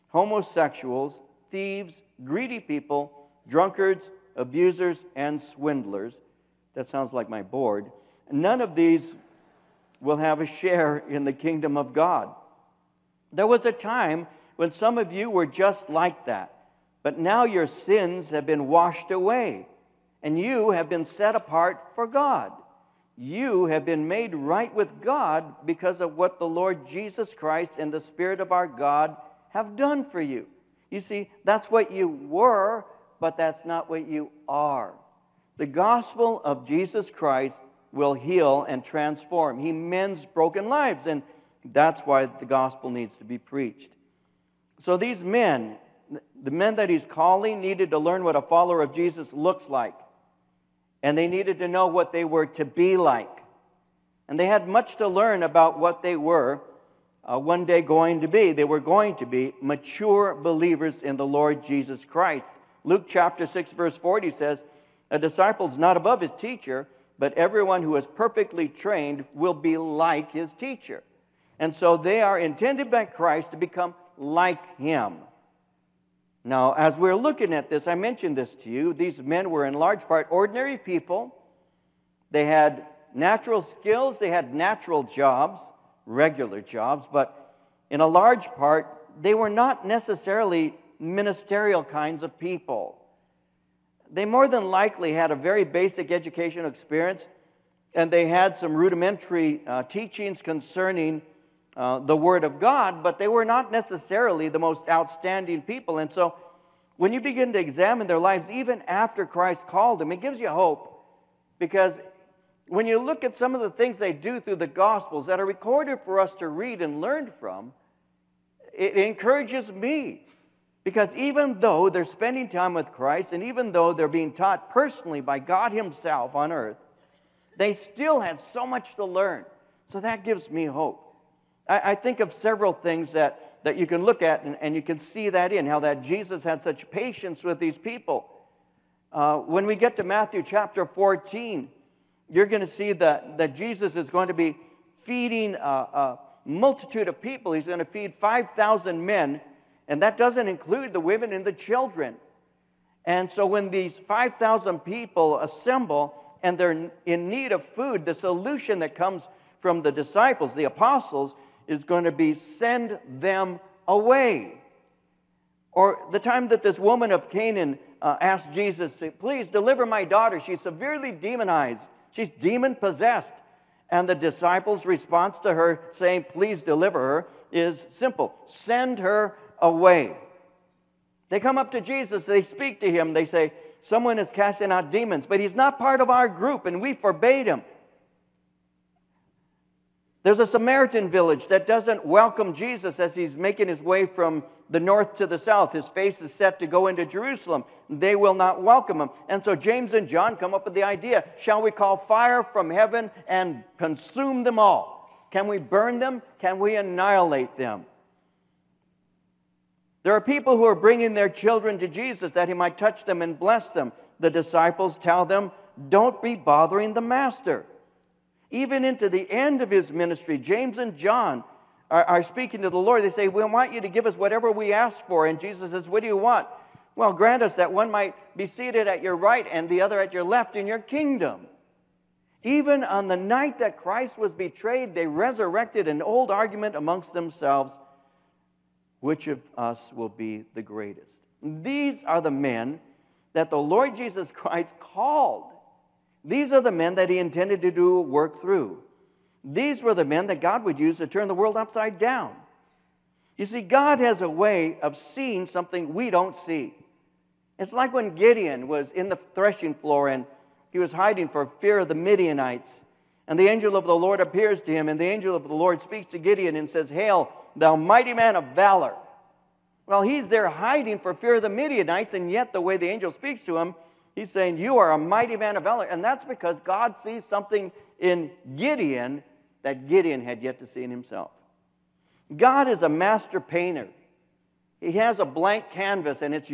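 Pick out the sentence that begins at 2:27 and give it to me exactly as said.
He's going to feed 5,000 men and that doesn't include the women and the children.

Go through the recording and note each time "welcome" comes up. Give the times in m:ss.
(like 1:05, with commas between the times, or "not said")
3:12, 3:18.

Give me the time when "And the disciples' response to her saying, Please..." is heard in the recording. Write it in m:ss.
2:53.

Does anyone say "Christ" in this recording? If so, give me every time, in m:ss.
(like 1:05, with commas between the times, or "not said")
0:27, 0:37, 1:02, 1:13, 1:49, 2:02, 3:53, 4:04.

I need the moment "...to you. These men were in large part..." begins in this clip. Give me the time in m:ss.
1:18.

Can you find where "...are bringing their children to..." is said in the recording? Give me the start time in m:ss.
3:30.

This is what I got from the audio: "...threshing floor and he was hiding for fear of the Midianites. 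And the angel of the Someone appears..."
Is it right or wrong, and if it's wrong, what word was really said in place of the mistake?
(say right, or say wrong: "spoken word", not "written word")
wrong: "Lord", not "Someone".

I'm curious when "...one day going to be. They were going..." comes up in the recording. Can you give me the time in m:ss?
0:57.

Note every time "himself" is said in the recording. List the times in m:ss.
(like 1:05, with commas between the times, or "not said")
2:05, 4:40.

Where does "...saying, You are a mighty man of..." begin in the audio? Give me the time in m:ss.
4:34.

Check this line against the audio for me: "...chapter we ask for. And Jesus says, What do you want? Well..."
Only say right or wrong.
wrong.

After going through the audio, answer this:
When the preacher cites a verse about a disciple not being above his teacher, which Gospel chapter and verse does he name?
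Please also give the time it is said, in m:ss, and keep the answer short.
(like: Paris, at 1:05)
Luke 6:40, at 1:02.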